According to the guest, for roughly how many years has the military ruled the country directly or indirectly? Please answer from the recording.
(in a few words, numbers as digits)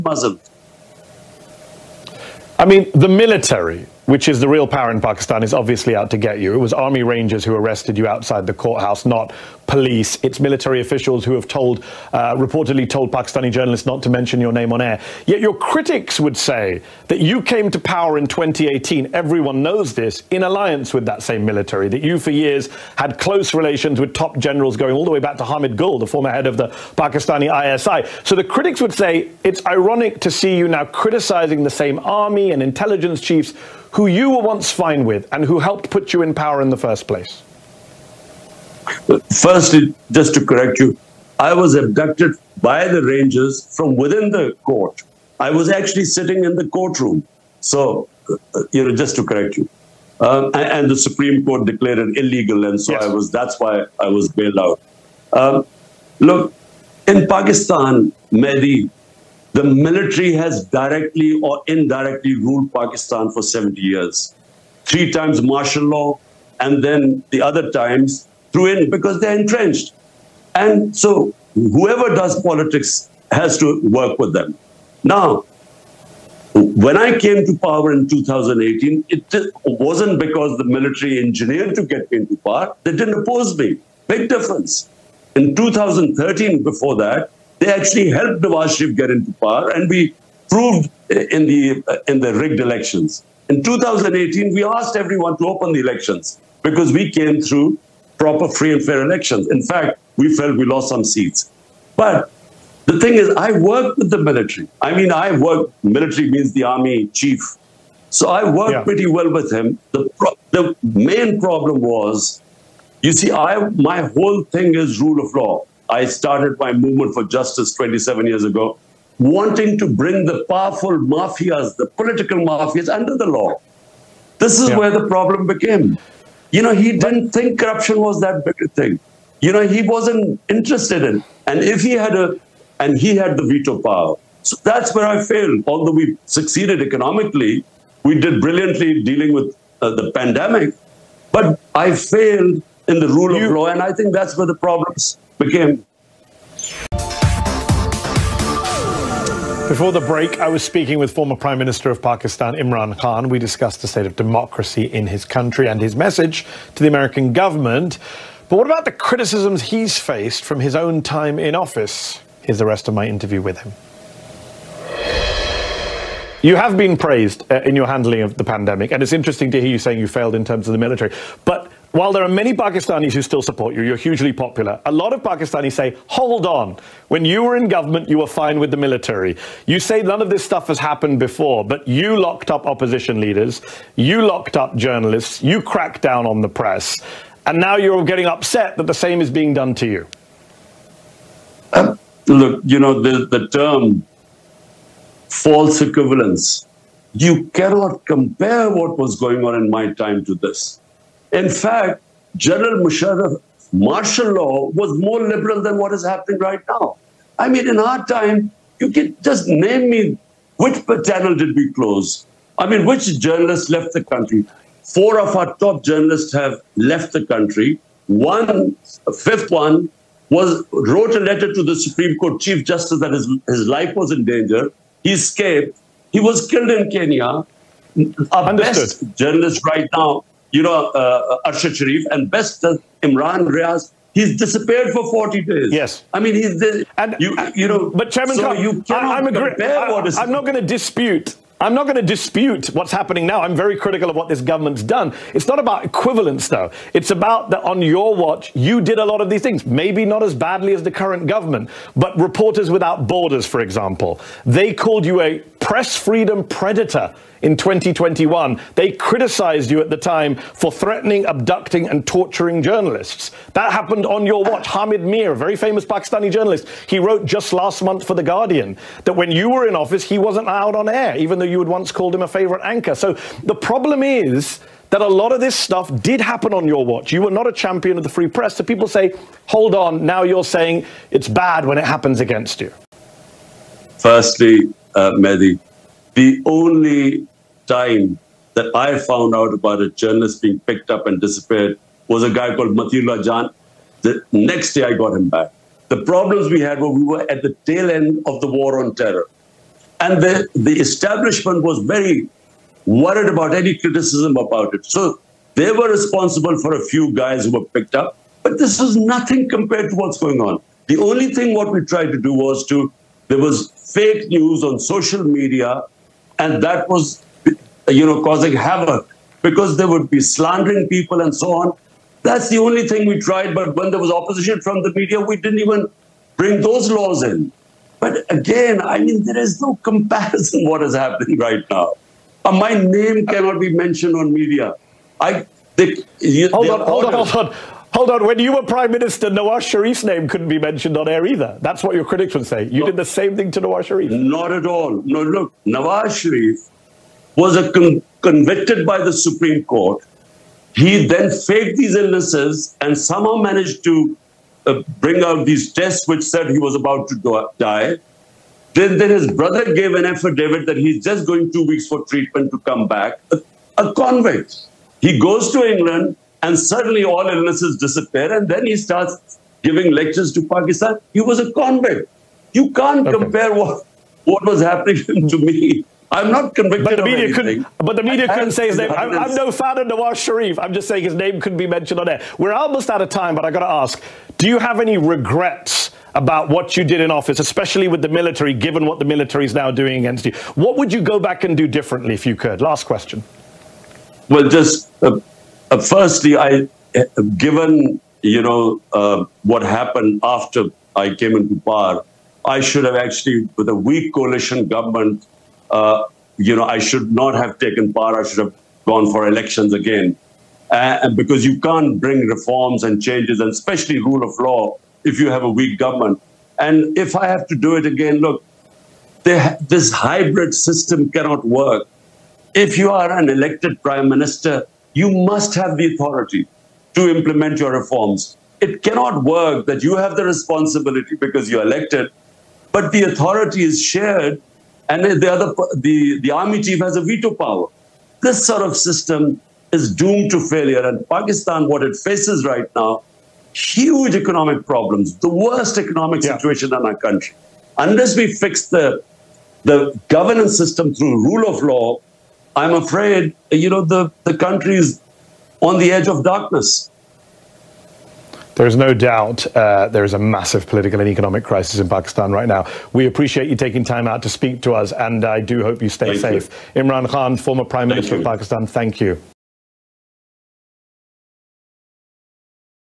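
70 years.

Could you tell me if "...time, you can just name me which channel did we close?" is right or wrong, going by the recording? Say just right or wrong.
right.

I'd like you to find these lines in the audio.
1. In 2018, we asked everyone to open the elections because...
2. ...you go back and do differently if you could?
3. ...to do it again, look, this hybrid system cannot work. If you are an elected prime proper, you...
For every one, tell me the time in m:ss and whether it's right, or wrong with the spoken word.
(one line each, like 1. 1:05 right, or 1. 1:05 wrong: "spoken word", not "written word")
1. 1:33 right
2. 6:30 right
3. 6:57 wrong: "minister", not "proper".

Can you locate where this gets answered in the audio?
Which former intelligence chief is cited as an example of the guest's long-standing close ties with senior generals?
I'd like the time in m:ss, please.
0:25.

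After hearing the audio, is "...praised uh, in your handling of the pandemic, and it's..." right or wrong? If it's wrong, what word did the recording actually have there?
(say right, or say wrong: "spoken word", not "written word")
right.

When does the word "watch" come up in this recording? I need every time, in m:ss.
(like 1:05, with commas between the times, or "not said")
4:08, 4:24, 4:36.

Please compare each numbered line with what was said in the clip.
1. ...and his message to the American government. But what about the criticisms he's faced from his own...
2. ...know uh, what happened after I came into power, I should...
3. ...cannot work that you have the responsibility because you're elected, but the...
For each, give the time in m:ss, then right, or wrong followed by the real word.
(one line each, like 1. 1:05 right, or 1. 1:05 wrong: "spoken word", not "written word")
1. 2:35 right
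2. 6:38 right
3. 7:08 right.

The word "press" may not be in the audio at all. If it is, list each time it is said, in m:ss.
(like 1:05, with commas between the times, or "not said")
3:06, 4:15, 4:38.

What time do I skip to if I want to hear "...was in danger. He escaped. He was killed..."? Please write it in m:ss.
3:43.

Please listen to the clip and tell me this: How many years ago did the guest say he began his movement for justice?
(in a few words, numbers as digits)
27 years.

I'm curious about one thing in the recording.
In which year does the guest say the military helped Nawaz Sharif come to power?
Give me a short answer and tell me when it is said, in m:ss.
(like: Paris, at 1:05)
2013, at 1:25.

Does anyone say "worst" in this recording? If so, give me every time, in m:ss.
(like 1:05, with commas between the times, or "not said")
7:25.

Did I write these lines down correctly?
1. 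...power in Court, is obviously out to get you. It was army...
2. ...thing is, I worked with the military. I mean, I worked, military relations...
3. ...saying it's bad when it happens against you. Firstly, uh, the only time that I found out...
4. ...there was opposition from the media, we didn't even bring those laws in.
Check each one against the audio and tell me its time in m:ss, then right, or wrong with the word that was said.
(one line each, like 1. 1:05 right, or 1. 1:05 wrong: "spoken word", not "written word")
1. 0:04 wrong: "Pakistan", not "Court"
2. 1:42 wrong: "means", not "relations"
3. 4:40 right
4. 5:23 right.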